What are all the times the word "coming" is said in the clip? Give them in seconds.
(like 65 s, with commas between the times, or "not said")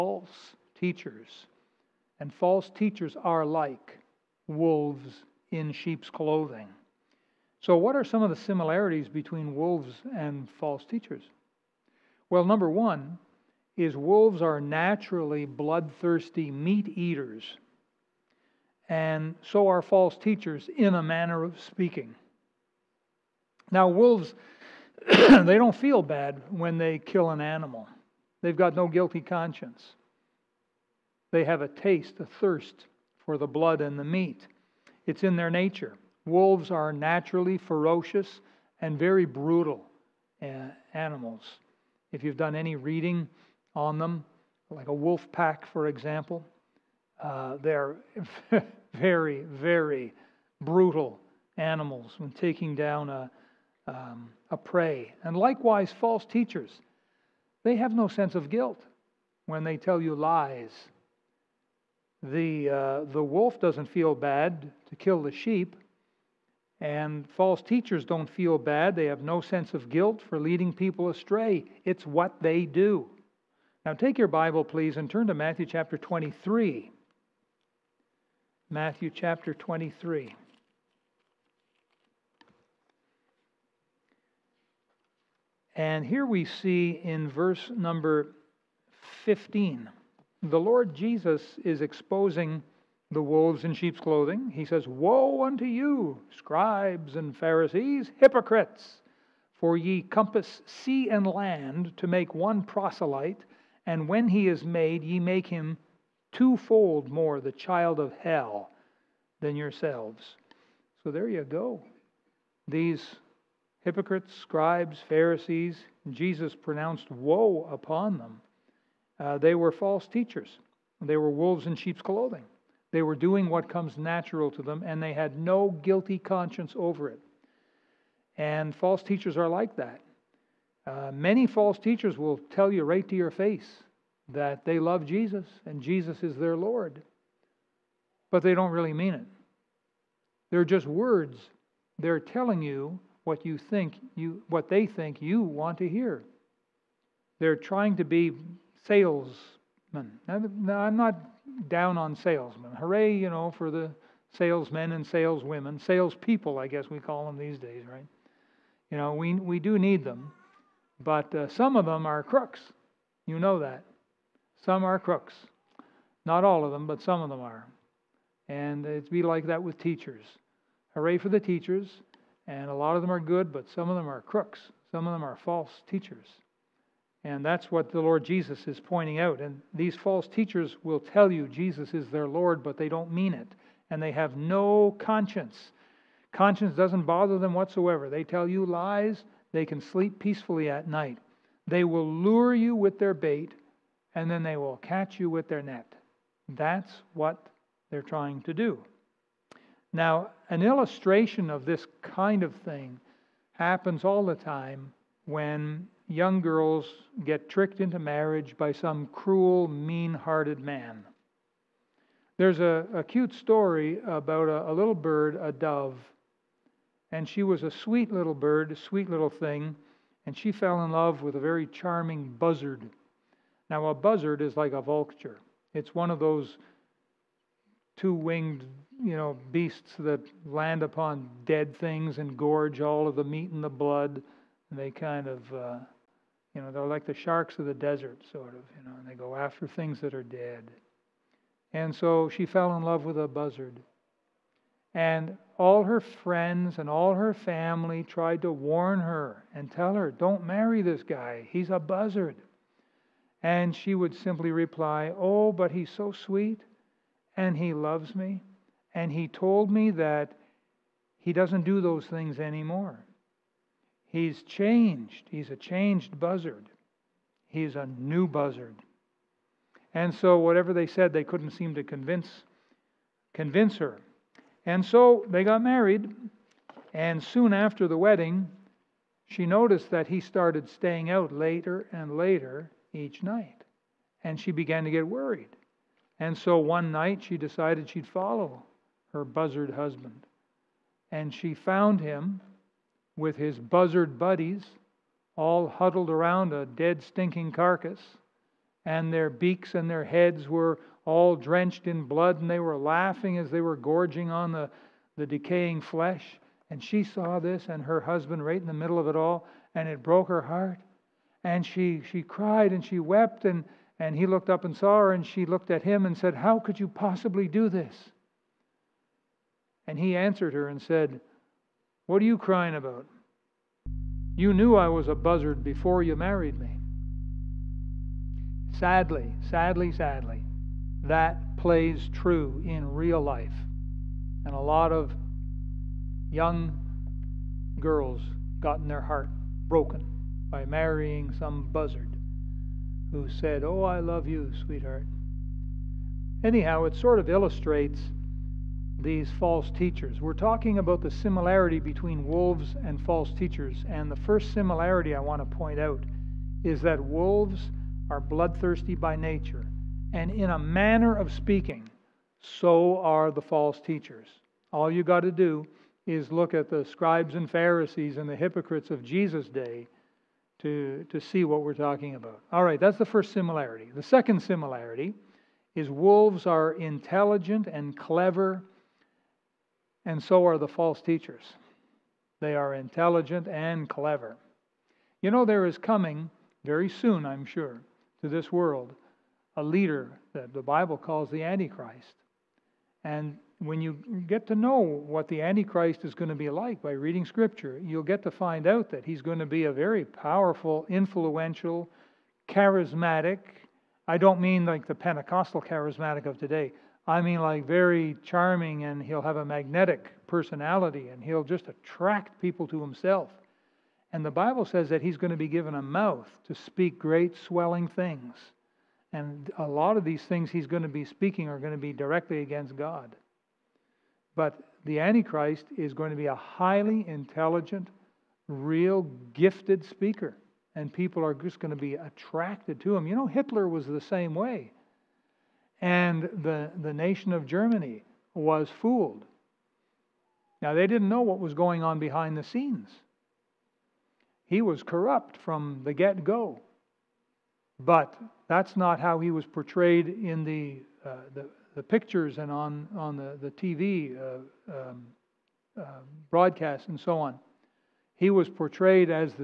385 s.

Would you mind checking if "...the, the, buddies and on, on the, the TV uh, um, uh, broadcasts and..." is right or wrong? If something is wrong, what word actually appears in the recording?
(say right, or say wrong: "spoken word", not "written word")
wrong: "pictures", not "buddies".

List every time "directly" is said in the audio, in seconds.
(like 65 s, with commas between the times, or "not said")
421 s.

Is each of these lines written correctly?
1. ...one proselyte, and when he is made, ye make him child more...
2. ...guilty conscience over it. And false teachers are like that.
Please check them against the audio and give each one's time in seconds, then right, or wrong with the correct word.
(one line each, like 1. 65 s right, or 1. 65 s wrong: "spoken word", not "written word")
1. 102 s wrong: "twofold", not "child"
2. 125 s right.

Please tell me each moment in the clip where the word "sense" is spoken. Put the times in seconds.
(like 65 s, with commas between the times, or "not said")
58 s, 69 s.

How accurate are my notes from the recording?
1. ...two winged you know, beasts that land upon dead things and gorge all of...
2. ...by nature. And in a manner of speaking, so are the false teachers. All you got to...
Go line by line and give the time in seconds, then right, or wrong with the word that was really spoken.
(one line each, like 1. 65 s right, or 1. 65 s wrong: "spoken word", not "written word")
1. 227 s right
2. 358 s right.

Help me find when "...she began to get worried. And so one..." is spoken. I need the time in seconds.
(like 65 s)
284 s.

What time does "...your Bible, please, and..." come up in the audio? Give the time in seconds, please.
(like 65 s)
74 s.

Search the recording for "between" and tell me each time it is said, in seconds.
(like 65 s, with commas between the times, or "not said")
9 s, 351 s.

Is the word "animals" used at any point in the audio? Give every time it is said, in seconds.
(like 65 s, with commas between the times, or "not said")
27 s, 40 s, 51 s.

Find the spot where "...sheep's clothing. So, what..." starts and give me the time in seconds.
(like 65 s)
5 s.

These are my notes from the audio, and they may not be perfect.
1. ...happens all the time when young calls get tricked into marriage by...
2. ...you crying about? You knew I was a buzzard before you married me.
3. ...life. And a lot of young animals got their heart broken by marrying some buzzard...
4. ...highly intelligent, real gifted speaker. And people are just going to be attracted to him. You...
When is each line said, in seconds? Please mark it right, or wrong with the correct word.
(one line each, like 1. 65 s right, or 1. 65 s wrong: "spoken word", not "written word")
1. 203 s wrong: "girls", not "calls"
2. 322 s right
3. 333 s wrong: "girls", not "animals"
4. 426 s right.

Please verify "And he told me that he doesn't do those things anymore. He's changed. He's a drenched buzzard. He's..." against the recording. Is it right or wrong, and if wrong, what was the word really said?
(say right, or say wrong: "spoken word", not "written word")
wrong: "changed", not "drenched".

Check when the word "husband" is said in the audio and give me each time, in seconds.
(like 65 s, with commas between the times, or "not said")
289 s, 308 s.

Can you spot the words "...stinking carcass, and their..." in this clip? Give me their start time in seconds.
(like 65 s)
297 s.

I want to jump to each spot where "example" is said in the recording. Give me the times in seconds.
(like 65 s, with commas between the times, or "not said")
45 s.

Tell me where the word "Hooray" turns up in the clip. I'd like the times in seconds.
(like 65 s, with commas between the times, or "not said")
152 s, 170 s.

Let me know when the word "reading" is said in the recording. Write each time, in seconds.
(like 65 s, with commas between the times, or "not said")
42 s, 396 s.